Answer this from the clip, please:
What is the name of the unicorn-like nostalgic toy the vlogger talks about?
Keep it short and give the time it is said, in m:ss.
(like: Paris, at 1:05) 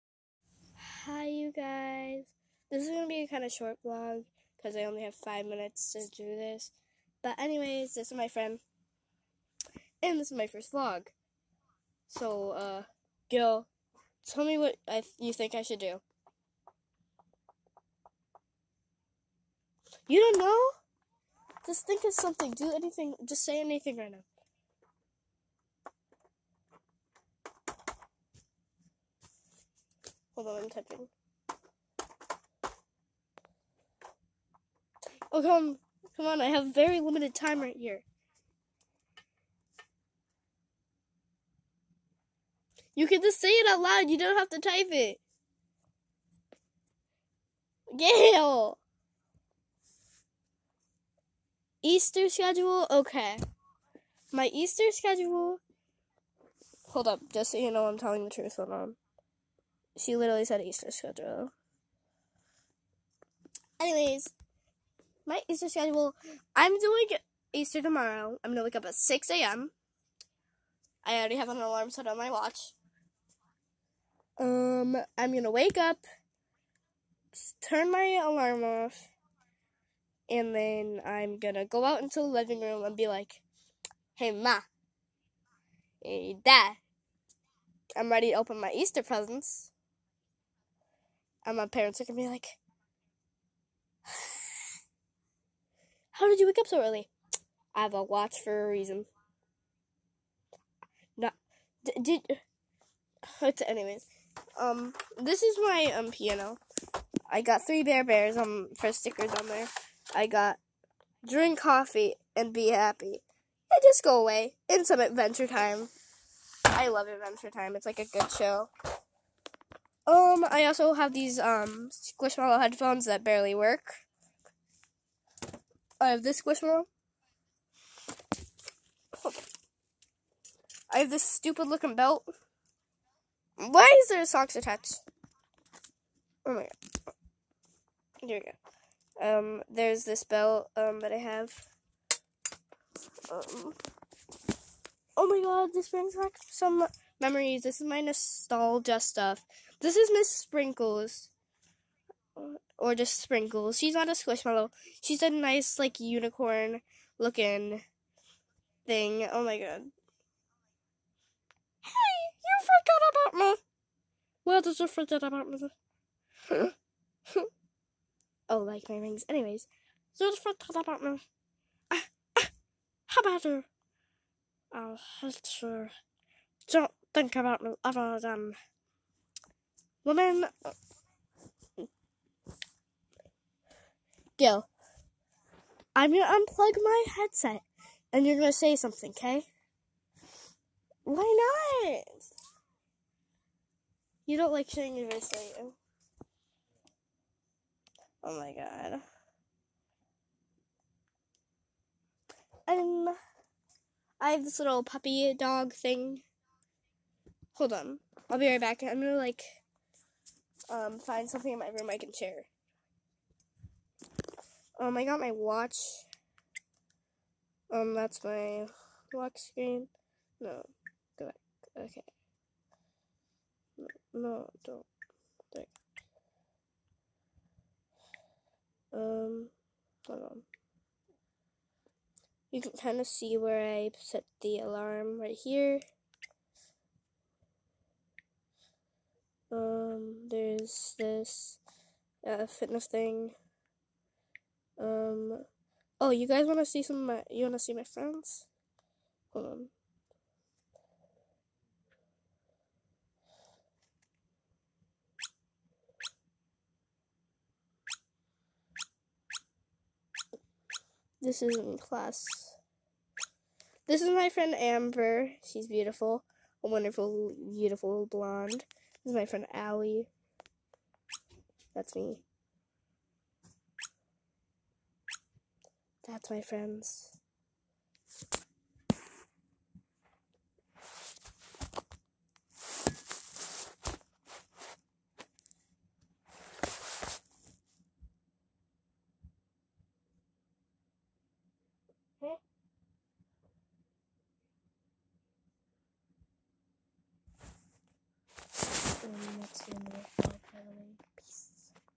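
Miss Sprinkles, at 2:30.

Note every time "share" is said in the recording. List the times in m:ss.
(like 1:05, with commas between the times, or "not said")
3:32.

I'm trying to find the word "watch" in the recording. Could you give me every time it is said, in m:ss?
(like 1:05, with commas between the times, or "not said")
1:12, 1:38, 3:35.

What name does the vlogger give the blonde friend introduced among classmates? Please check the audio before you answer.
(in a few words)
Amber.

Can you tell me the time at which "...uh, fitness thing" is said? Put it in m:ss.
4:02.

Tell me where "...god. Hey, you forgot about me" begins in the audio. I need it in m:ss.
2:39.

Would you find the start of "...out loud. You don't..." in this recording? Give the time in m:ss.
0:43.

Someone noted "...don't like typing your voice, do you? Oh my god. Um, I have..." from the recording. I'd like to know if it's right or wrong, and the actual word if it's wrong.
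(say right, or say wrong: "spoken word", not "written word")
wrong: "showing", not "typing".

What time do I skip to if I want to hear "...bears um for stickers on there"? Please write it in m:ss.
1:48.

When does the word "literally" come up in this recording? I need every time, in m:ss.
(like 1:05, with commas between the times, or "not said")
1:00.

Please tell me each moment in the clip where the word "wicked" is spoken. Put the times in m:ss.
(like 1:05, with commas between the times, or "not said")
not said.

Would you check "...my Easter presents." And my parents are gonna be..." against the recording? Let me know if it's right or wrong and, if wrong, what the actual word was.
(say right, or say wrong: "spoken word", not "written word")
right.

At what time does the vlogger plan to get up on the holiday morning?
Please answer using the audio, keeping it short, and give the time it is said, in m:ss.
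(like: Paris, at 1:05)
6 a.m., at 1:08.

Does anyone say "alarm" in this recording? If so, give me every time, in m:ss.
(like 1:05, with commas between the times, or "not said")
1:11, 1:18, 3:54.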